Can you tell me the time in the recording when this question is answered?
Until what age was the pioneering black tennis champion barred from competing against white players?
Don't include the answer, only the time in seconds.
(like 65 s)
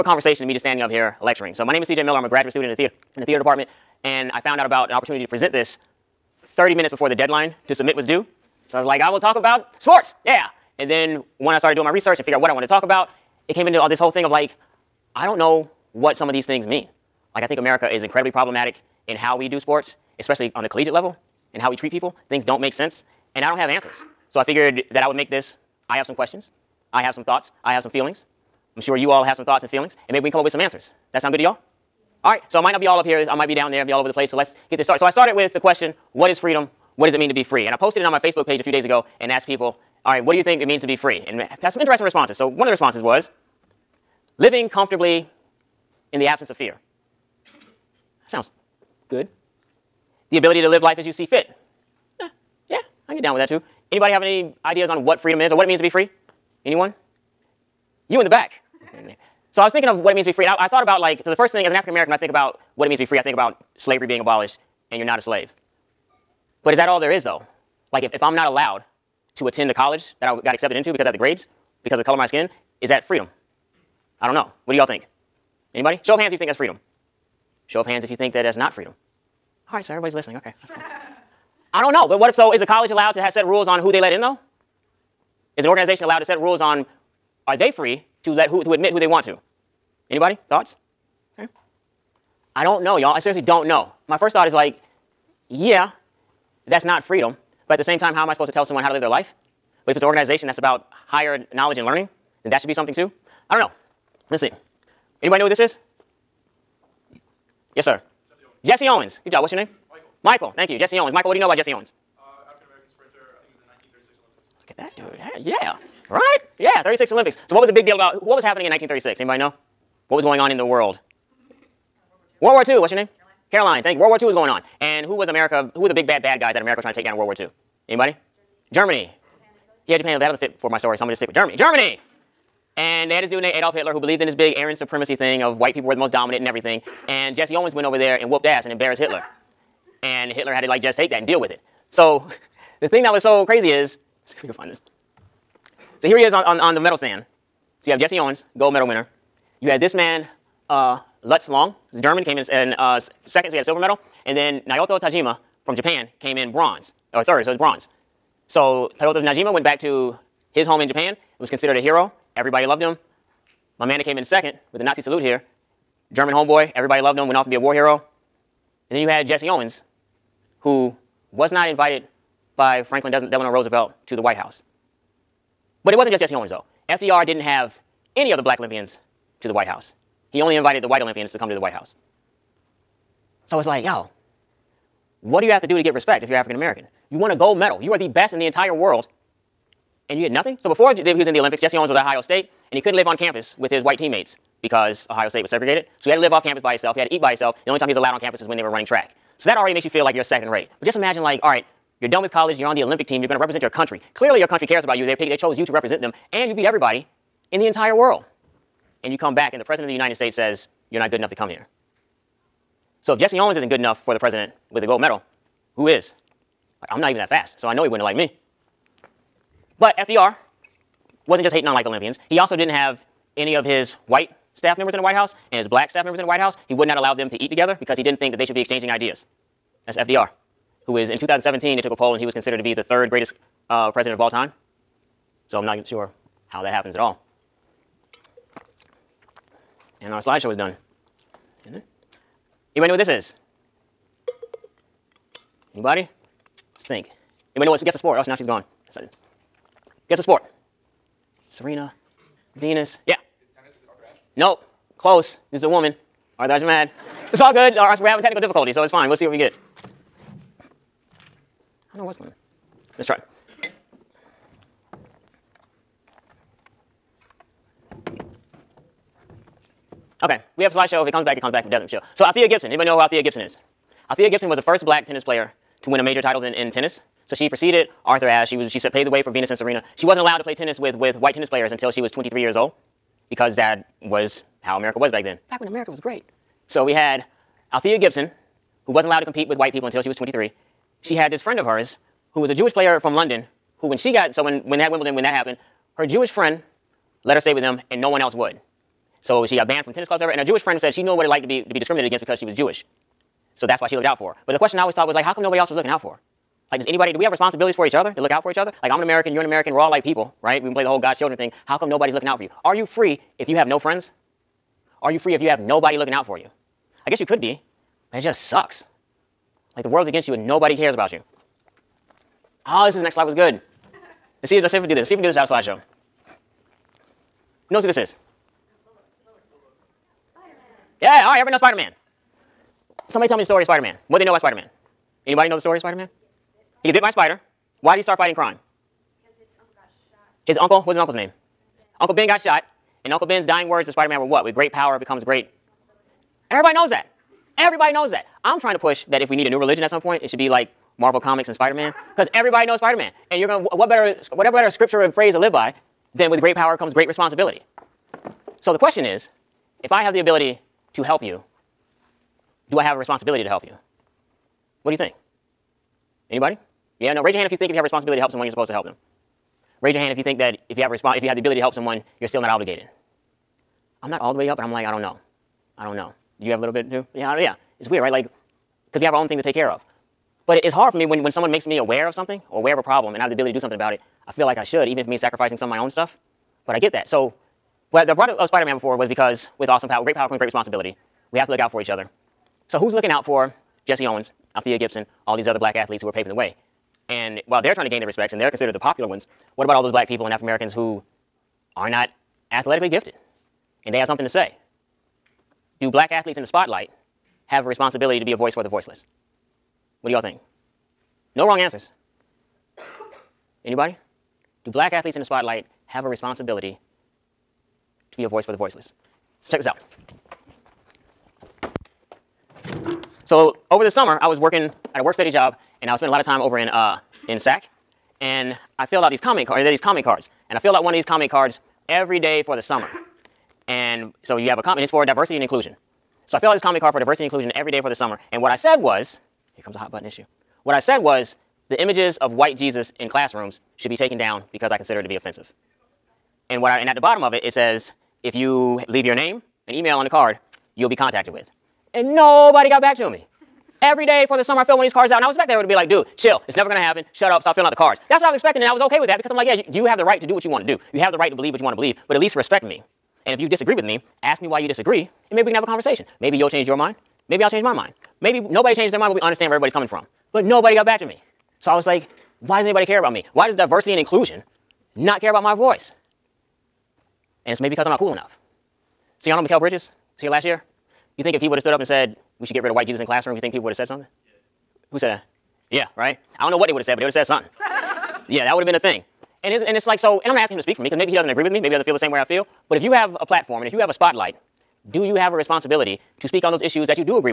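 282 s.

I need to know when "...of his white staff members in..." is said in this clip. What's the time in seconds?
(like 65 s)
223 s.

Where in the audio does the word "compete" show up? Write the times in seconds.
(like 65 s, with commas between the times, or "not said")
289 s.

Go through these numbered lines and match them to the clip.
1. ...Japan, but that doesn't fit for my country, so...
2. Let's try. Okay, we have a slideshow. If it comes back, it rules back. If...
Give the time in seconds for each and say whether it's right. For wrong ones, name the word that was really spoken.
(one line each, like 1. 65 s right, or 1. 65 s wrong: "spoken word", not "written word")
1. 129 s wrong: "story", not "country"
2. 262 s wrong: "comes", not "rules".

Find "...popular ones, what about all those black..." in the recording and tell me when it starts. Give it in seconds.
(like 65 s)
398 s.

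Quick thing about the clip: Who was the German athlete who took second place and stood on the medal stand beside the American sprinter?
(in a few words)
Lutz Long.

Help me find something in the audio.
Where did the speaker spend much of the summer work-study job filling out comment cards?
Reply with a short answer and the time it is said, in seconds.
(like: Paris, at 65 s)
SAC, at 427 s.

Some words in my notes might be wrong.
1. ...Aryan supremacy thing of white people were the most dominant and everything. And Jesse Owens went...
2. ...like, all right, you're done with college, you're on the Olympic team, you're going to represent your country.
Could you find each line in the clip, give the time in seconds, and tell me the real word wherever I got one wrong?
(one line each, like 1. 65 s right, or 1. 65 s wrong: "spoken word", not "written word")
1. 134 s right
2. 201 s right.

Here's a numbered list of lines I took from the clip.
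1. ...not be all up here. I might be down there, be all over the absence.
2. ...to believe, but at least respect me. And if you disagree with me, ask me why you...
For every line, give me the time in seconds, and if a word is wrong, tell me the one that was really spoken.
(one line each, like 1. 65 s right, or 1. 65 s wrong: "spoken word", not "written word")
1. 32 s wrong: "place", not "absence"
2. 461 s right.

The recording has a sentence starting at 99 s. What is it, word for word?
But if it's an organization that's about higher knowledge and learning, then that should be something too.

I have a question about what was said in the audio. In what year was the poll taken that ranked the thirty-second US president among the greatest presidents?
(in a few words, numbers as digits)
2017.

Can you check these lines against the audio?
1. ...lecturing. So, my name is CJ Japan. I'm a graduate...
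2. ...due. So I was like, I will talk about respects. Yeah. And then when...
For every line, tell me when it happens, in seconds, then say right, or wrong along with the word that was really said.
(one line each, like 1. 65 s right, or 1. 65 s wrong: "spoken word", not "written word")
1. 1 s wrong: "Miller", not "Japan"
2. 8 s wrong: "sports", not "respects".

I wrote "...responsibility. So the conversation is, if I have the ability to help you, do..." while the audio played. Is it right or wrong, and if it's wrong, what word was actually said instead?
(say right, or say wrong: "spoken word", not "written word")
wrong: "question", not "conversation".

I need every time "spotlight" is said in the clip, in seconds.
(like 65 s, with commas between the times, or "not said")
406 s, 415 s, 493 s.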